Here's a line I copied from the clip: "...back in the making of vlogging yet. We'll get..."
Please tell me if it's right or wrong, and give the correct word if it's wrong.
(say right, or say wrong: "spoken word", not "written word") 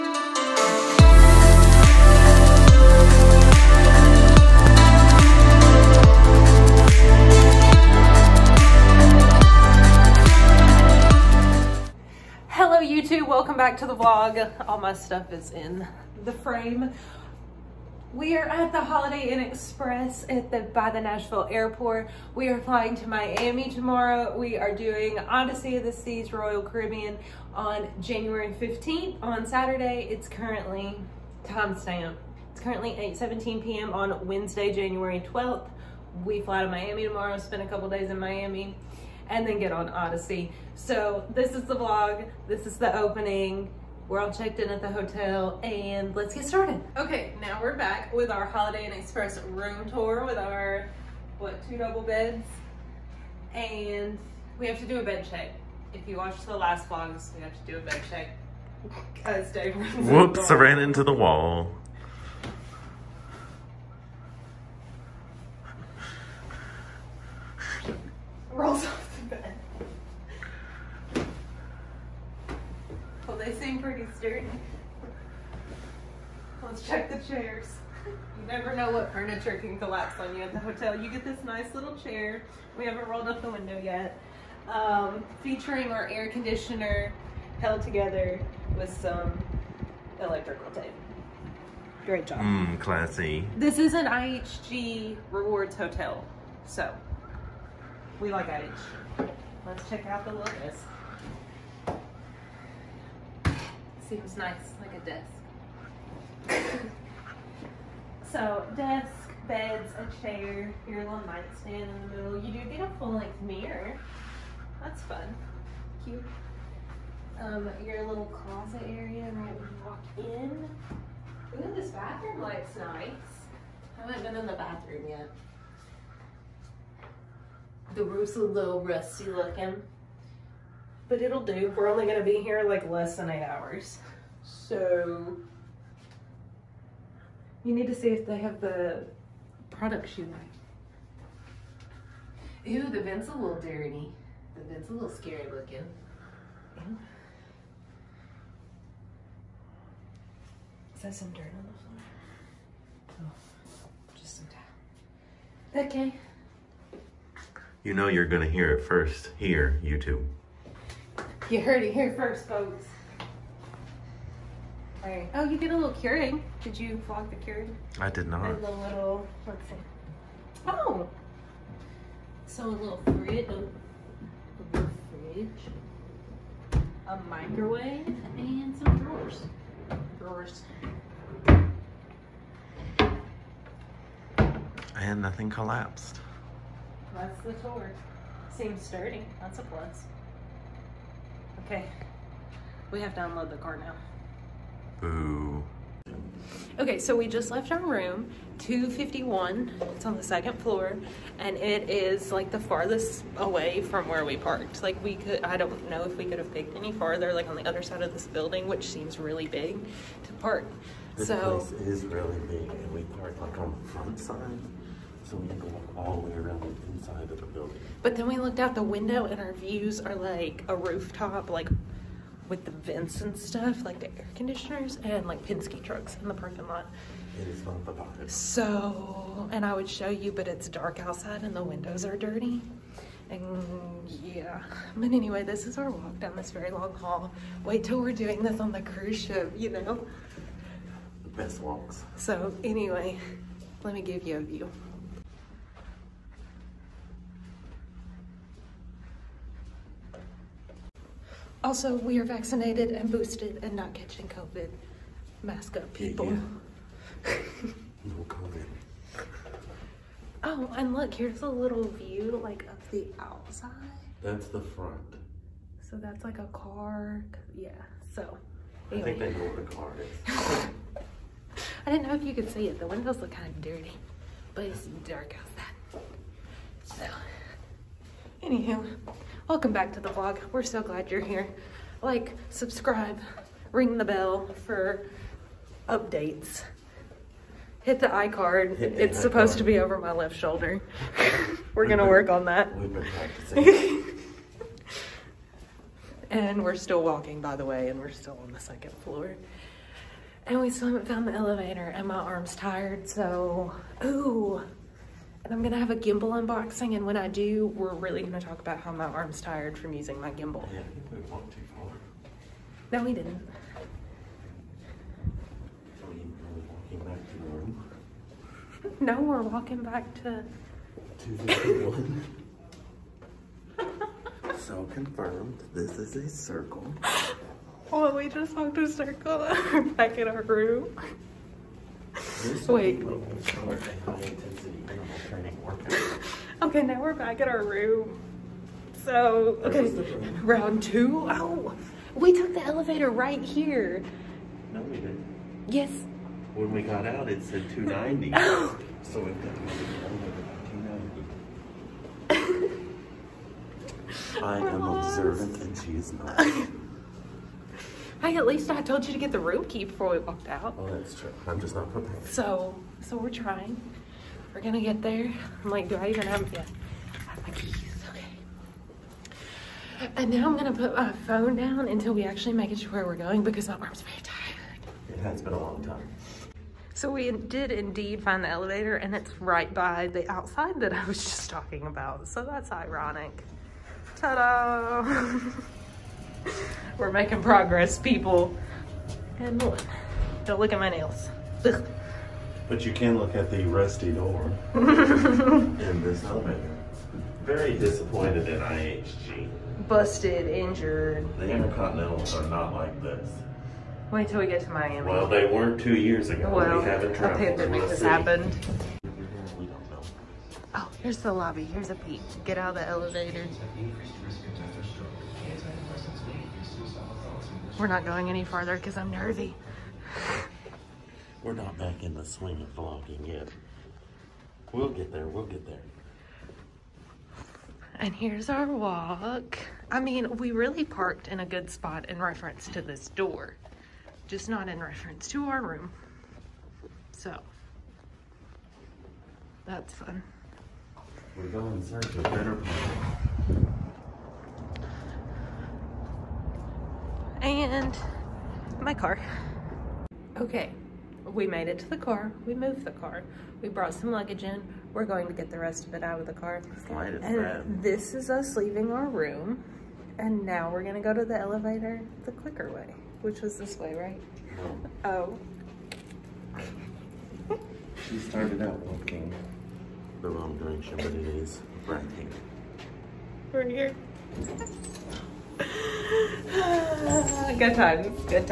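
wrong: "swing", not "making".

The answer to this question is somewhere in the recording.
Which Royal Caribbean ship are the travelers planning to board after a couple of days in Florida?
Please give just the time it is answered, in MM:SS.
00:25.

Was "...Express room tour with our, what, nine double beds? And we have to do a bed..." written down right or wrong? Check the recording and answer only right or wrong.
wrong.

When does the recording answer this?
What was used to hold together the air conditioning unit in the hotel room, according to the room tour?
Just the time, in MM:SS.
01:30.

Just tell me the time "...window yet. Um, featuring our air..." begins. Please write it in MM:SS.
01:23.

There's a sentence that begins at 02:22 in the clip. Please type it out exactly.
Ew, the vent's a little dirty.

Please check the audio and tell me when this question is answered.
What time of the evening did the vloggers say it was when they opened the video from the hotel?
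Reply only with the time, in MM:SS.
00:32.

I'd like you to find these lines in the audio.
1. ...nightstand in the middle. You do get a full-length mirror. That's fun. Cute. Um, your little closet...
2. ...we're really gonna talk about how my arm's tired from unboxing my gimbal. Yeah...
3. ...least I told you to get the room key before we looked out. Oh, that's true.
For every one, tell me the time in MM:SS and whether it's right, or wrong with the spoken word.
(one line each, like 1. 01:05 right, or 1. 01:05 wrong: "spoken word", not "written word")
1. 01:51 right
2. 05:07 wrong: "using", not "unboxing"
3. 05:58 wrong: "walked", not "looked".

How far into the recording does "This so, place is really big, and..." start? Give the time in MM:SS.
03:31.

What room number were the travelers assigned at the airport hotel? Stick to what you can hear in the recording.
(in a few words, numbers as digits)
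251.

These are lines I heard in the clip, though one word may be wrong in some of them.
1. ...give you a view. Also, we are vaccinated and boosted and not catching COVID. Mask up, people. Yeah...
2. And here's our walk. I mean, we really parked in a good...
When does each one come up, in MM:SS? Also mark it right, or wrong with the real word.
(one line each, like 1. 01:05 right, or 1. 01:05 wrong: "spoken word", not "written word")
1. 04:04 right
2. 07:07 right.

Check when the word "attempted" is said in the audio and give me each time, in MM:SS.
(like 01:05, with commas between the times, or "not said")
not said.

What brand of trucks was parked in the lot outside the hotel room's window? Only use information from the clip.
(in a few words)
Penske.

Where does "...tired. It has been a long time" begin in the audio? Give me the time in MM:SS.
06:14.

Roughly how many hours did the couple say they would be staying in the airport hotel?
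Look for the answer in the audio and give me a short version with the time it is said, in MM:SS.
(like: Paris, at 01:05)
less than 8, at 02:12.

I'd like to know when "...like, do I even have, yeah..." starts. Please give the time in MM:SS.
06:05.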